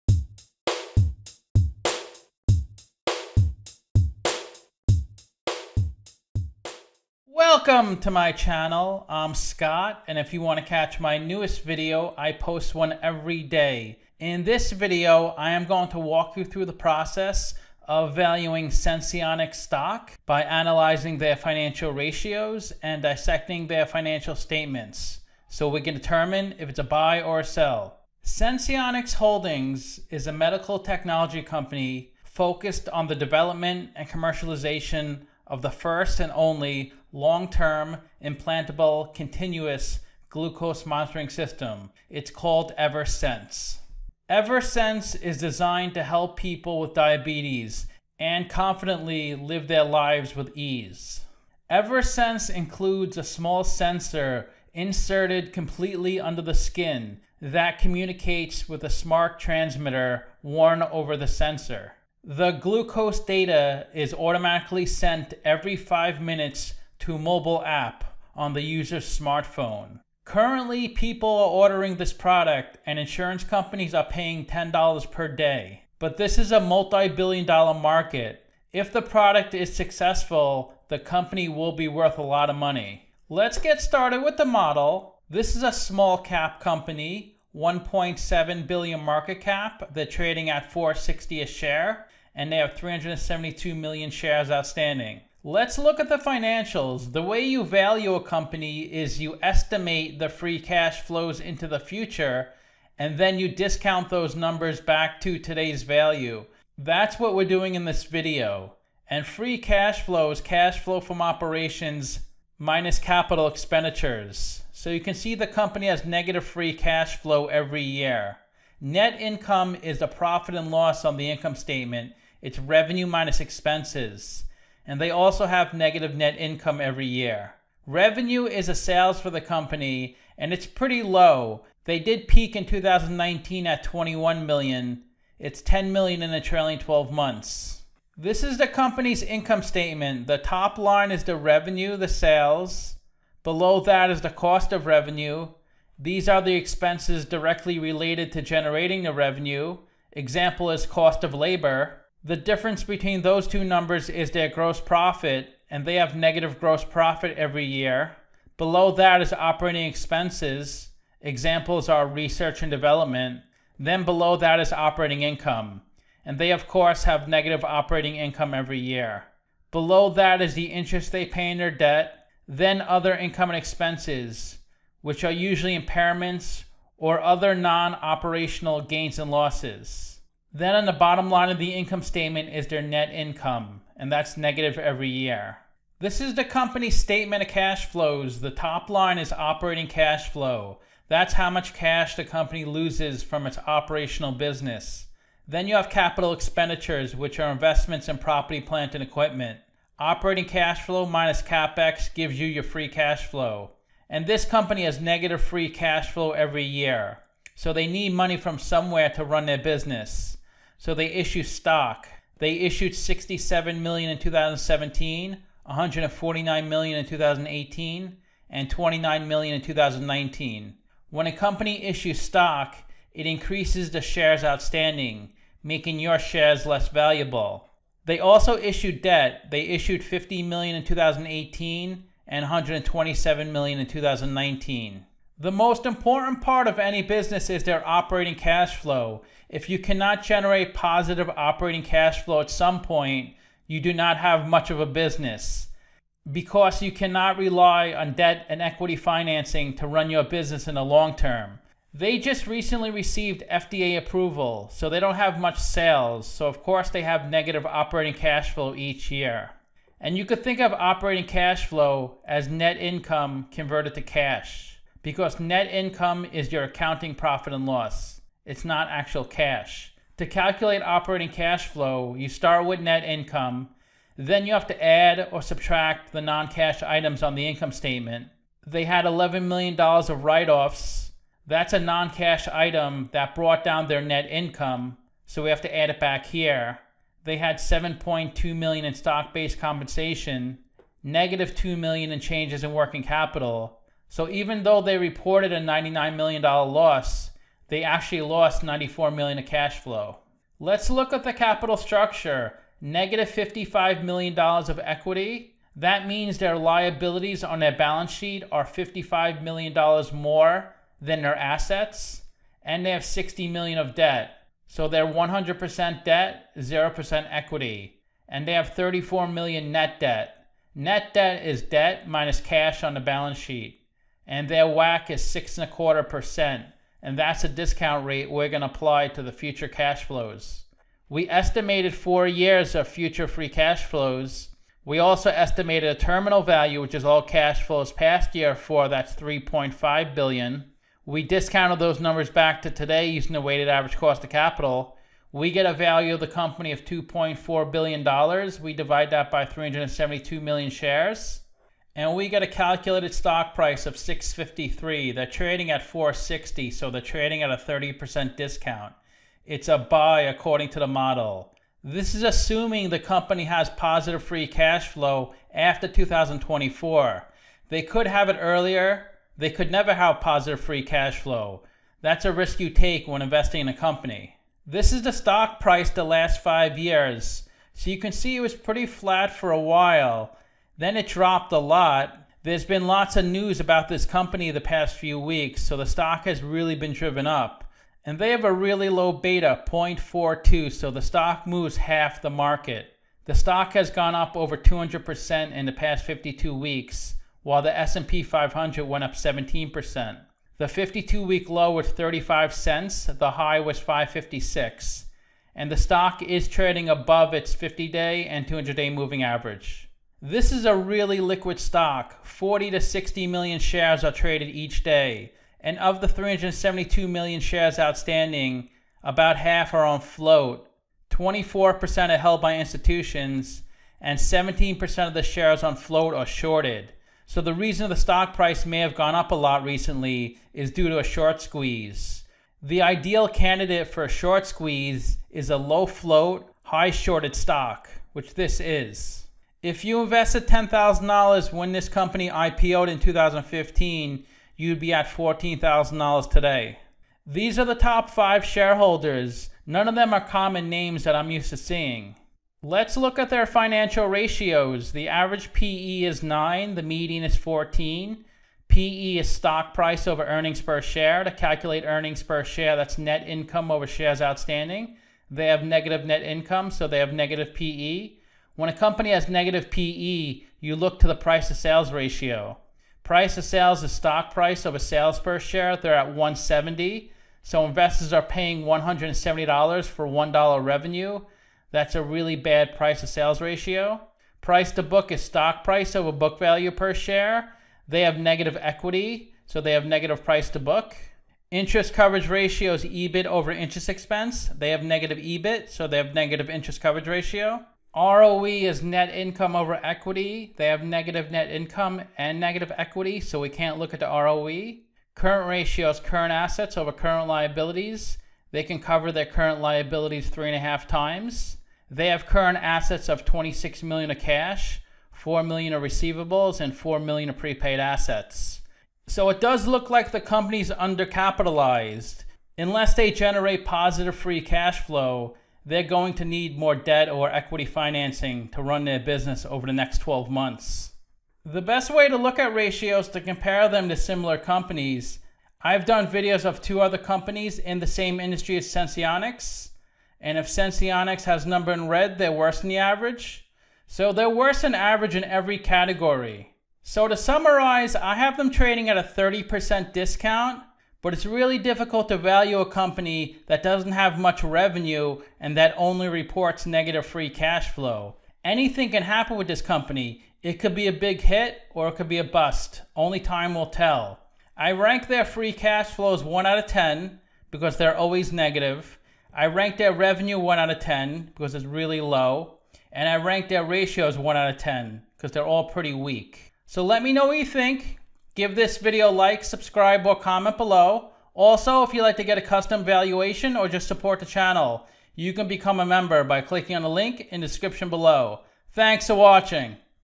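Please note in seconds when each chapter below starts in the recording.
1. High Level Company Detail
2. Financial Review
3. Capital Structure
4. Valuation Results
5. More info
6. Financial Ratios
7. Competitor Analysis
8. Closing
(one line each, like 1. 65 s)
1. 28 s
2. 95 s
3. 300 s
4. 331 s
5. 374 s
6. 452 s
7. 531 s
8. 546 s.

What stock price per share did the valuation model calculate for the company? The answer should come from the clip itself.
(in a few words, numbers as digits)
653.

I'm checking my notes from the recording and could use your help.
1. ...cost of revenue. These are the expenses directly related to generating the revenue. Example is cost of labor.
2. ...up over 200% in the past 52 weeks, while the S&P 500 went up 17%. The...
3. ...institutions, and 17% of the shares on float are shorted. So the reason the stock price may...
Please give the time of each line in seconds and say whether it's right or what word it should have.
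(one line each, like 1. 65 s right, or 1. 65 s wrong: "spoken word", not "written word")
1. 144 s right
2. 394 s right
3. 422 s right.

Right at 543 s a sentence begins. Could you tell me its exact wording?
So they're worse than average in every category.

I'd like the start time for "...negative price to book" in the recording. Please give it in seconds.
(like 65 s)
489 s.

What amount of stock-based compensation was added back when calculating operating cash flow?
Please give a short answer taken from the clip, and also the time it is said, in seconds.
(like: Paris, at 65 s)
7.2 million, at 287 s.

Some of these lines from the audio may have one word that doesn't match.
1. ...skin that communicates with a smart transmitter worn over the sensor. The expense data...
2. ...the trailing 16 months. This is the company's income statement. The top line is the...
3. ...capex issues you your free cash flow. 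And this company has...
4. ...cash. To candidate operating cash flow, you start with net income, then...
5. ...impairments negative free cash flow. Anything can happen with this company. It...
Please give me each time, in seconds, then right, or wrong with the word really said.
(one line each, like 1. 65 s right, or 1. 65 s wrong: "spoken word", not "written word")
1. 56 s wrong: "glucose", not "expense"
2. 136 s wrong: "12", not "16"
3. 201 s wrong: "gives", not "issues"
4. 269 s wrong: "calculate", not "candidate"
5. 556 s wrong: "reports", not "impairments".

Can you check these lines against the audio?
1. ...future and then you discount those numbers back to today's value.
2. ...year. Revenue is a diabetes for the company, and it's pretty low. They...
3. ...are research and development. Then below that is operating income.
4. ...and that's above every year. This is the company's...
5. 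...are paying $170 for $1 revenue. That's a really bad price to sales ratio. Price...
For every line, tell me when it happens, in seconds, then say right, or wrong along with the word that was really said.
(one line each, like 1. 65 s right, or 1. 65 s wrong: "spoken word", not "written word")
1. 101 s right
2. 127 s wrong: "sales", not "diabetes"
3. 161 s right
4. 183 s wrong: "negative", not "above"
5. 478 s right.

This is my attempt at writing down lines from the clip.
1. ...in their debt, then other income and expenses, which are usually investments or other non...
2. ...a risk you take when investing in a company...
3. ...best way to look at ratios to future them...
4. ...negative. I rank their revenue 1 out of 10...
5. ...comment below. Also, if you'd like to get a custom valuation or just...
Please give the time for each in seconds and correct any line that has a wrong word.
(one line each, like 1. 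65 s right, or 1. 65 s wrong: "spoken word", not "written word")
1. 171 s wrong: "impairments", not "investments"
2. 372 s right
3. 531 s wrong: "compare", not "future"
4. 568 s right
5. 580 s right.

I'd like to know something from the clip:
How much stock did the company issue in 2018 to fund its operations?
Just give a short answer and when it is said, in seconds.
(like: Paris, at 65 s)
149 million, at 215 s.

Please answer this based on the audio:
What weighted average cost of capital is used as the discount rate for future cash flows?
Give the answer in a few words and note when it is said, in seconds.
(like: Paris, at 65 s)
6.25%, at 325 s.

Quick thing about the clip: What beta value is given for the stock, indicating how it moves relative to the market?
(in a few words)
0.42.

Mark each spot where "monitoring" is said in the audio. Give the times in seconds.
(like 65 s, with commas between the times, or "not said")
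40 s.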